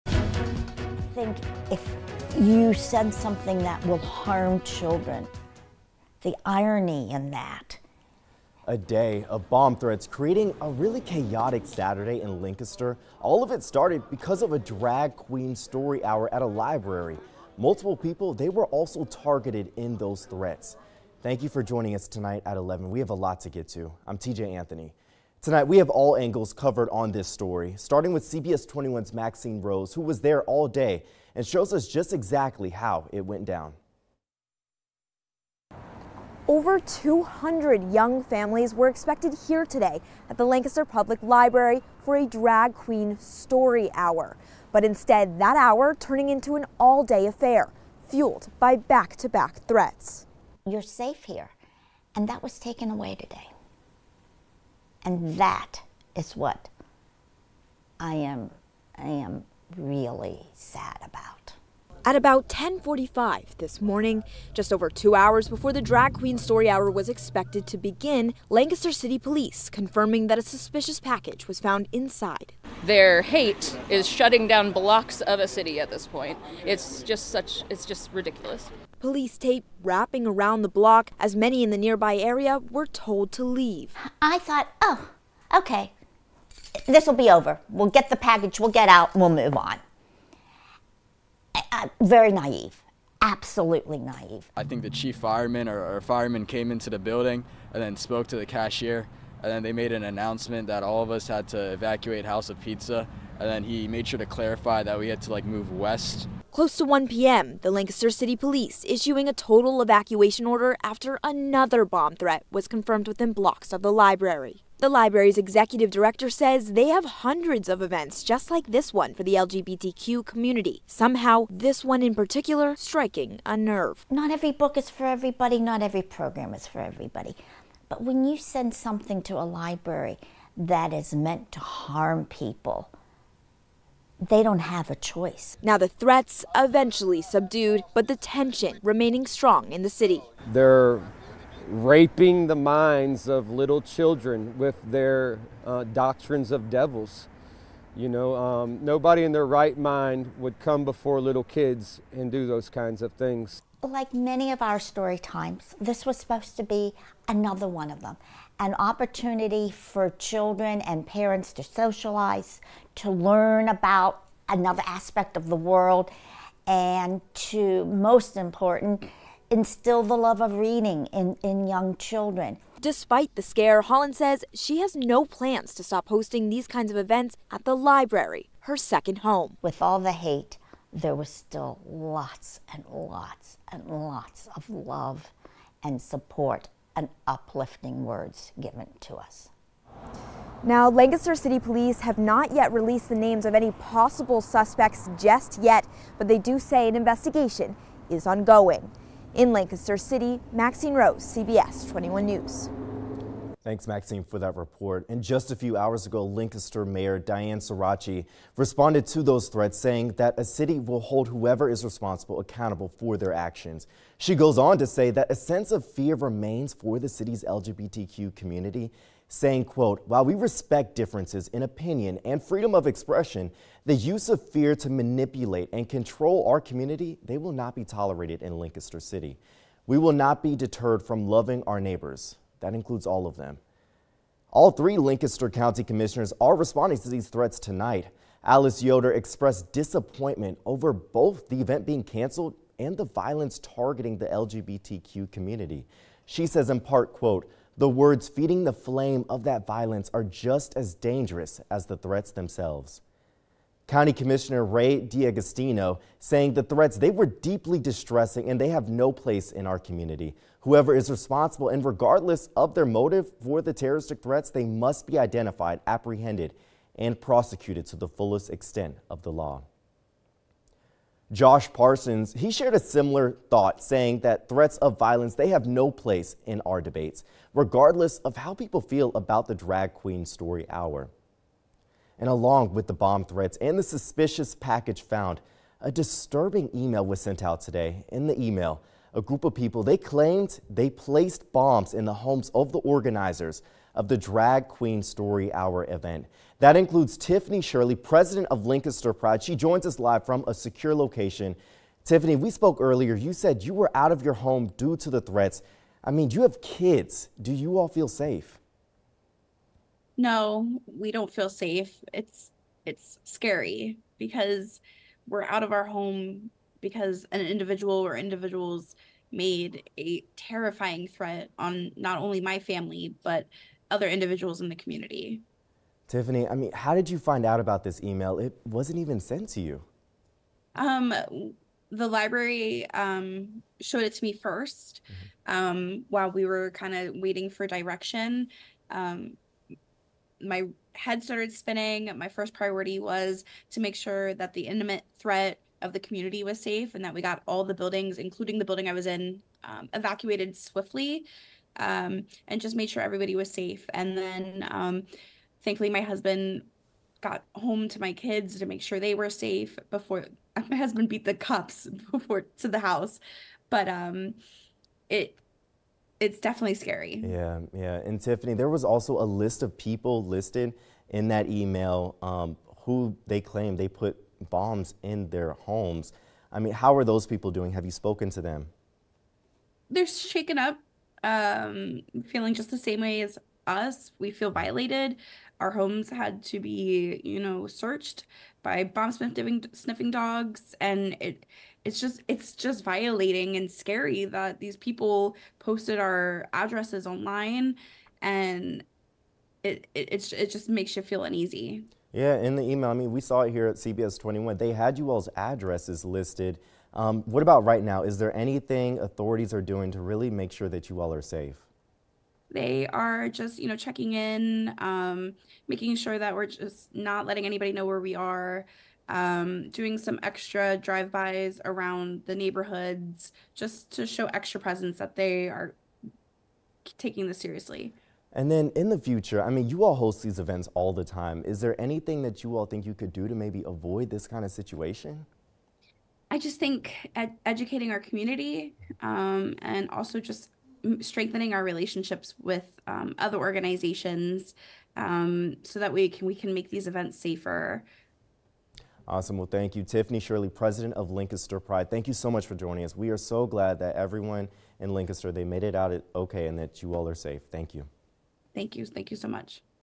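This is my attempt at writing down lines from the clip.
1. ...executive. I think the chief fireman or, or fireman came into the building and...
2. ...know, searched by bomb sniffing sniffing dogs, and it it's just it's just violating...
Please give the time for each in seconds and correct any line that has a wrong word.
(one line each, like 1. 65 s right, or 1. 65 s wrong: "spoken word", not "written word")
1. 93 s wrong: "naive", not "executive"
2. 387 s right.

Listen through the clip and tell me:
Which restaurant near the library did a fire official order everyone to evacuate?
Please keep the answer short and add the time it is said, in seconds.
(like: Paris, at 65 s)
House of Pizza, at 102 s.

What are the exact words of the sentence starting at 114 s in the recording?
The library's executive director says they have hundreds of events just like this one for the LGBTQ community.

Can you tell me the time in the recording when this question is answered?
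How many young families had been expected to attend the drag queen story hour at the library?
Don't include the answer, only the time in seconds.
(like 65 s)
36 s.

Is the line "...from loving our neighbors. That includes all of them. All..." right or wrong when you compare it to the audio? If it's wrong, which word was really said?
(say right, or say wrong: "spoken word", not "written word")
right.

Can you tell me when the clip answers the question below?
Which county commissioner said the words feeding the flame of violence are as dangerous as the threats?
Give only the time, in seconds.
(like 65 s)
238 s.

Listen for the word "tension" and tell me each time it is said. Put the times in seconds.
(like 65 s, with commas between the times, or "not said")
138 s.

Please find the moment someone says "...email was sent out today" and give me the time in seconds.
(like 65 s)
286 s.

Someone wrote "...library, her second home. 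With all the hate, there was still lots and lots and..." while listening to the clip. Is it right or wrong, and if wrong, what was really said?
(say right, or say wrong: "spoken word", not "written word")
right.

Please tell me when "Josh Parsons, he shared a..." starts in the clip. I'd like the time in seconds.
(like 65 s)
271 s.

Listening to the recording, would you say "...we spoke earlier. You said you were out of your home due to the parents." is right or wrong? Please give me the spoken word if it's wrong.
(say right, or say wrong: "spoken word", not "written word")
wrong: "threats", not "parents".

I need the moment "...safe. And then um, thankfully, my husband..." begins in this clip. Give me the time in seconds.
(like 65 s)
353 s.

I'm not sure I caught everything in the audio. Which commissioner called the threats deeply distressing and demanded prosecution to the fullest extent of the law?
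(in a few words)
Ray D'Agostino.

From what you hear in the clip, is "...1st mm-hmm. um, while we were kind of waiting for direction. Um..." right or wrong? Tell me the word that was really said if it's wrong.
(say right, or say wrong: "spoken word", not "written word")
right.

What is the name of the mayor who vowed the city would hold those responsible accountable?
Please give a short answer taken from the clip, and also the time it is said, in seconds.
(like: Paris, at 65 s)
Danene Sorace, at 207 s.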